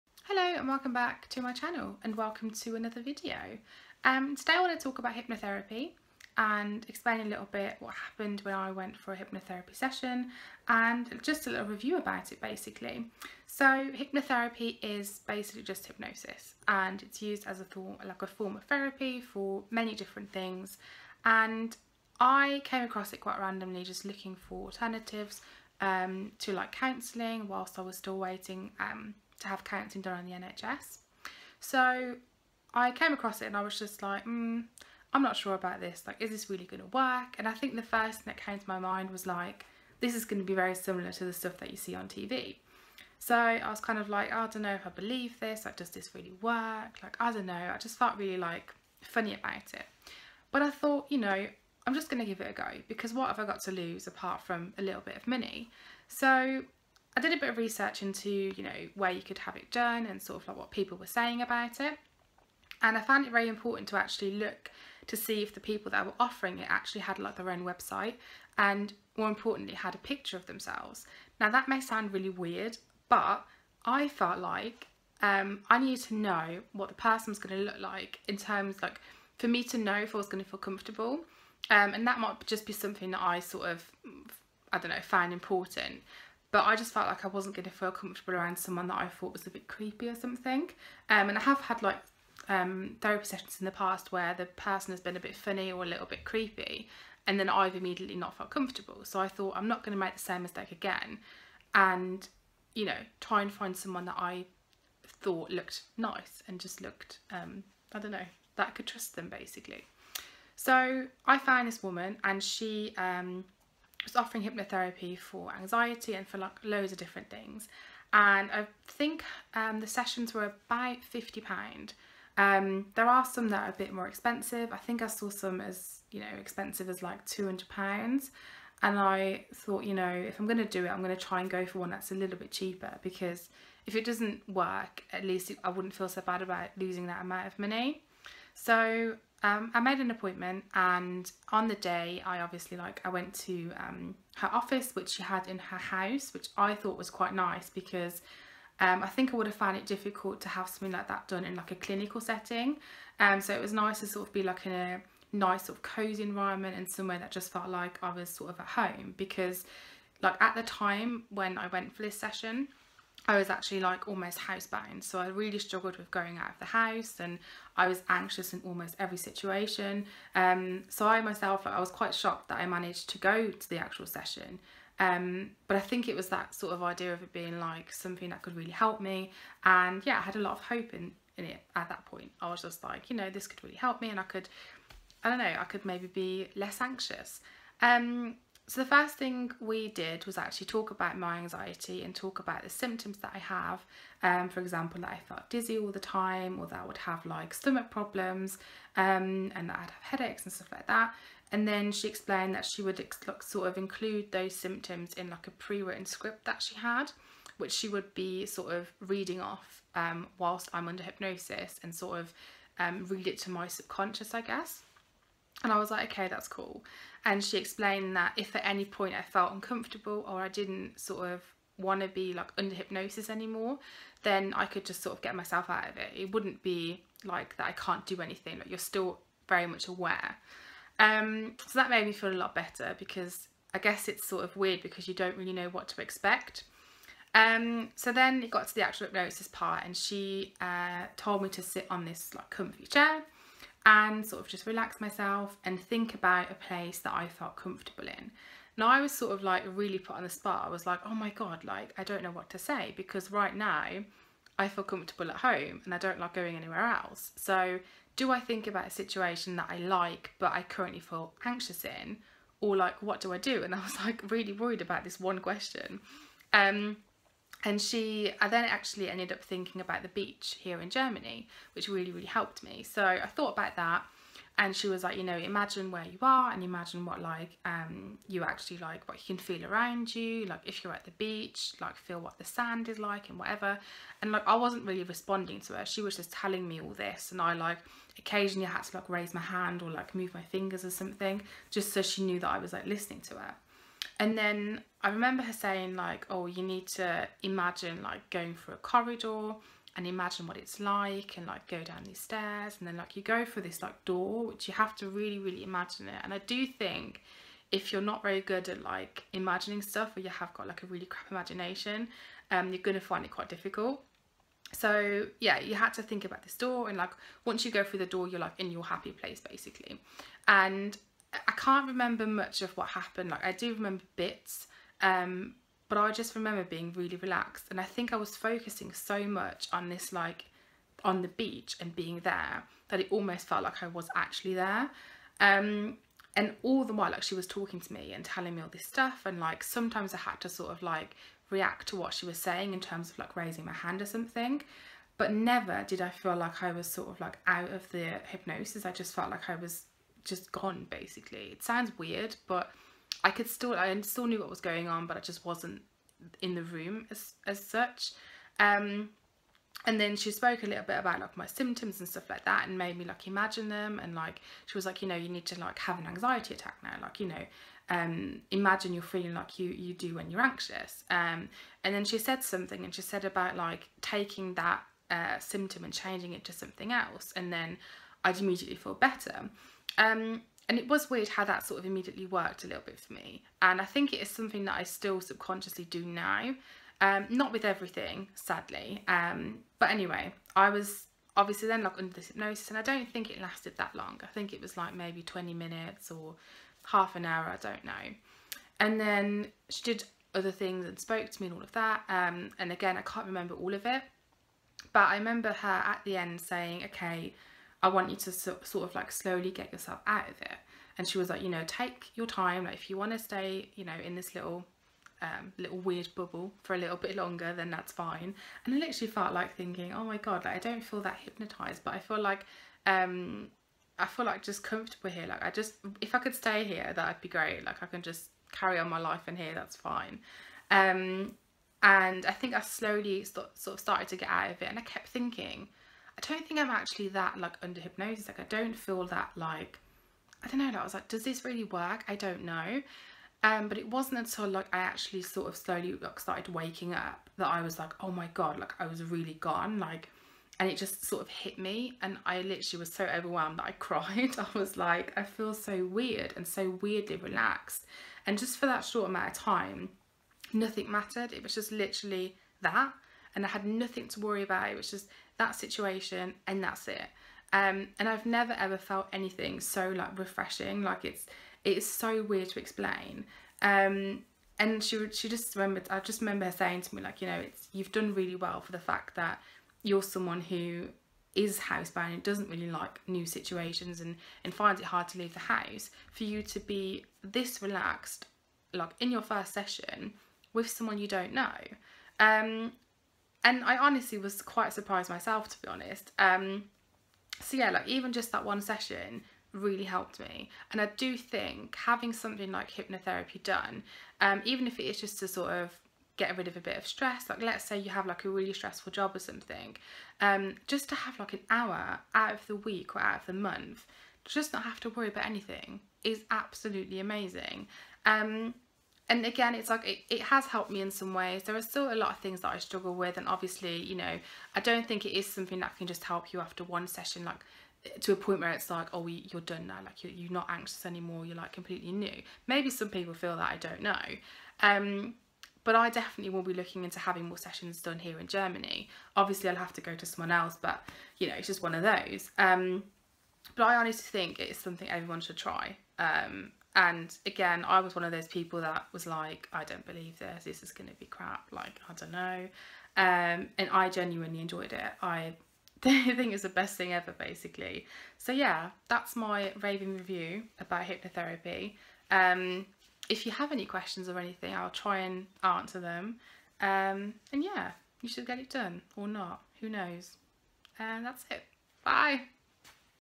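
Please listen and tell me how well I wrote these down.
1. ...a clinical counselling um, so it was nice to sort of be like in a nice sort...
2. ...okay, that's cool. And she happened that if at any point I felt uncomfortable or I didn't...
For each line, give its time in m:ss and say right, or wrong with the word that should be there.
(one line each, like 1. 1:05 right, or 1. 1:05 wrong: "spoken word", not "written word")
1. 2:31 wrong: "setting", not "counselling"
2. 3:36 wrong: "explained", not "happened".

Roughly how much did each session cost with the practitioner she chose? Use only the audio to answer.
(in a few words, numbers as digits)
£50.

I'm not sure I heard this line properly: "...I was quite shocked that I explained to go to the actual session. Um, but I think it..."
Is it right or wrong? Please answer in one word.
wrong.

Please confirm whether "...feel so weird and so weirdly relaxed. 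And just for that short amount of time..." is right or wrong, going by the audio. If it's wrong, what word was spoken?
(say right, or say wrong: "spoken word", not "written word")
right.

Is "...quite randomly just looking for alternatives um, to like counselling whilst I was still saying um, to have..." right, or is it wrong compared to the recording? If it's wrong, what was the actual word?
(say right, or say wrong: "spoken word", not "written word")
wrong: "waiting", not "saying".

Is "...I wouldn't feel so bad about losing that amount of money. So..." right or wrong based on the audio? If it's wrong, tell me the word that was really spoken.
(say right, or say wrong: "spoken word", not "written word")
right.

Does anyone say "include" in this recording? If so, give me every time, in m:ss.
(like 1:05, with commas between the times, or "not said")
3:23.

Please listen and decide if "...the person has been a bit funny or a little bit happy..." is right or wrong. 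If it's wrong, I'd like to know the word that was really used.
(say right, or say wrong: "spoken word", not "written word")
wrong: "creepy", not "happy".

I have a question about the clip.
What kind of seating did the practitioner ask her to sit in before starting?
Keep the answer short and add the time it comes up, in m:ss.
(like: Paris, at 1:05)
Comfy chair, at 4:02.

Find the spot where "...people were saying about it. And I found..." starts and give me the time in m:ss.
1:00.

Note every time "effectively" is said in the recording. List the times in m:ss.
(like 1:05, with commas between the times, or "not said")
not said.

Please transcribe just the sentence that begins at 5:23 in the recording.
Like I do remember bits, um, but I just remember being really relaxed.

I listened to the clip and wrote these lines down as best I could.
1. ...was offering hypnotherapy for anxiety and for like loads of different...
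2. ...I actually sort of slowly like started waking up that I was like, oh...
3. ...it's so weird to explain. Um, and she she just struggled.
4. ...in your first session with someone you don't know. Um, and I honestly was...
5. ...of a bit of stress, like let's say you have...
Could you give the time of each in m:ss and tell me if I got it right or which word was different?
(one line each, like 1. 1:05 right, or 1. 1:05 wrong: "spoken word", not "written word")
1. 1:54 right
2. 7:24 right
3. 7:51 wrong: "remembered", not "struggled"
4. 8:08 right
5. 8:26 right.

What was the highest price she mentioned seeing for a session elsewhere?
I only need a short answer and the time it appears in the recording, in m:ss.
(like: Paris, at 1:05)
£200, at 2:07.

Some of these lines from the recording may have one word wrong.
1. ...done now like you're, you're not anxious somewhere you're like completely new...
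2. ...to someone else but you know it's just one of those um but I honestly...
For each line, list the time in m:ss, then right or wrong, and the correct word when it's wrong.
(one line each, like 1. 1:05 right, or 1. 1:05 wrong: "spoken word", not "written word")
1. 8:49 wrong: "anymore", not "somewhere"
2. 8:59 right.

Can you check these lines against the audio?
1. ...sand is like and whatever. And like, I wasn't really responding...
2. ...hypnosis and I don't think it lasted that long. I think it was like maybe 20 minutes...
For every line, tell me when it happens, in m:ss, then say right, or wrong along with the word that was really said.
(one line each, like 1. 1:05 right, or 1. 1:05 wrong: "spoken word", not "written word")
1. 4:42 right
2. 6:32 right.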